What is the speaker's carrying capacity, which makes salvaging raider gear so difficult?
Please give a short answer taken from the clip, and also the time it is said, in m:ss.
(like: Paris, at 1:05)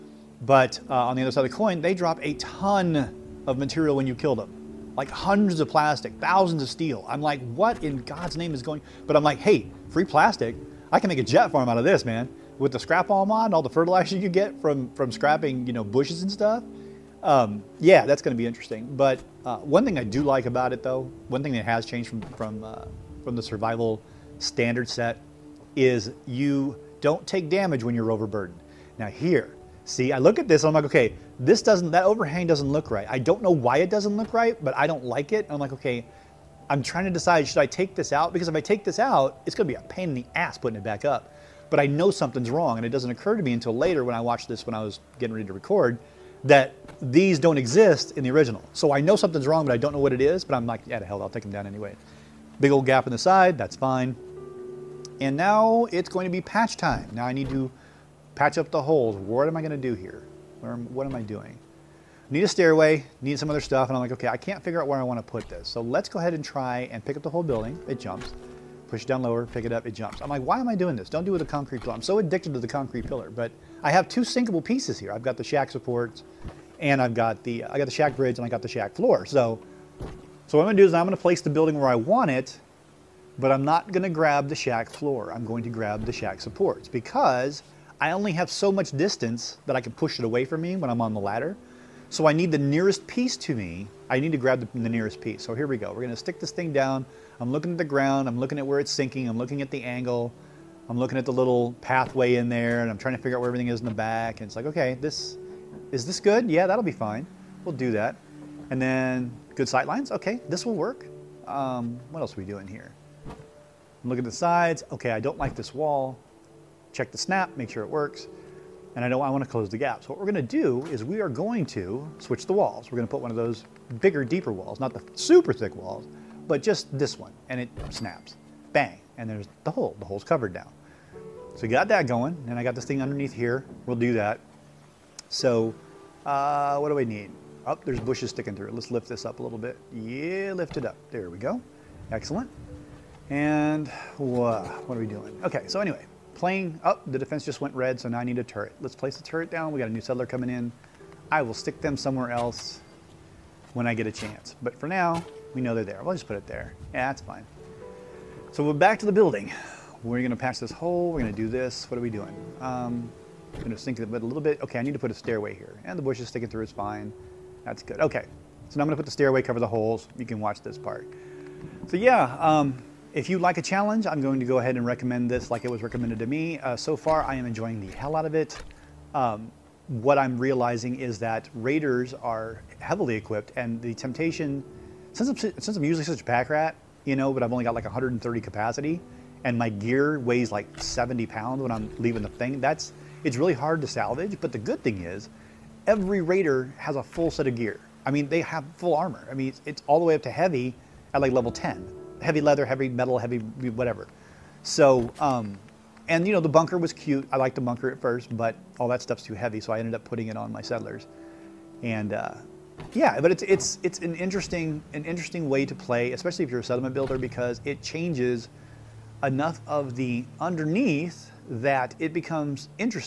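130, at 3:07.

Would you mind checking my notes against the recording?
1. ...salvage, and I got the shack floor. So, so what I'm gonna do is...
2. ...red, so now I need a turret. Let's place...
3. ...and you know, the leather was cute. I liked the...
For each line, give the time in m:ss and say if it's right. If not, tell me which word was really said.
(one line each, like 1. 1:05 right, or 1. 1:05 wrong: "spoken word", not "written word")
1. 1:18 wrong: "bridge", not "salvage"
2. 2:27 right
3. 3:26 wrong: "bunker", not "leather".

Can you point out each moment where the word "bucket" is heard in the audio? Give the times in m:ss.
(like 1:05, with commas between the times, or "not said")
not said.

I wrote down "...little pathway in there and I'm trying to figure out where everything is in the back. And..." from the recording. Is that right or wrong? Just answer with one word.
right.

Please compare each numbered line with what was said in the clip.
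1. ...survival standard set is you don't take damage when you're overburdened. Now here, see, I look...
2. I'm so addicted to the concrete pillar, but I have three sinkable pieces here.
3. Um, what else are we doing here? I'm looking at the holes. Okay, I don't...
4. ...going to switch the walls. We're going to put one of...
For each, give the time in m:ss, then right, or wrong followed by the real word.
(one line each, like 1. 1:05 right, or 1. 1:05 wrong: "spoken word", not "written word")
1. 0:23 right
2. 1:11 wrong: "two", not "three"
3. 1:51 wrong: "sides", not "holes"
4. 2:01 right.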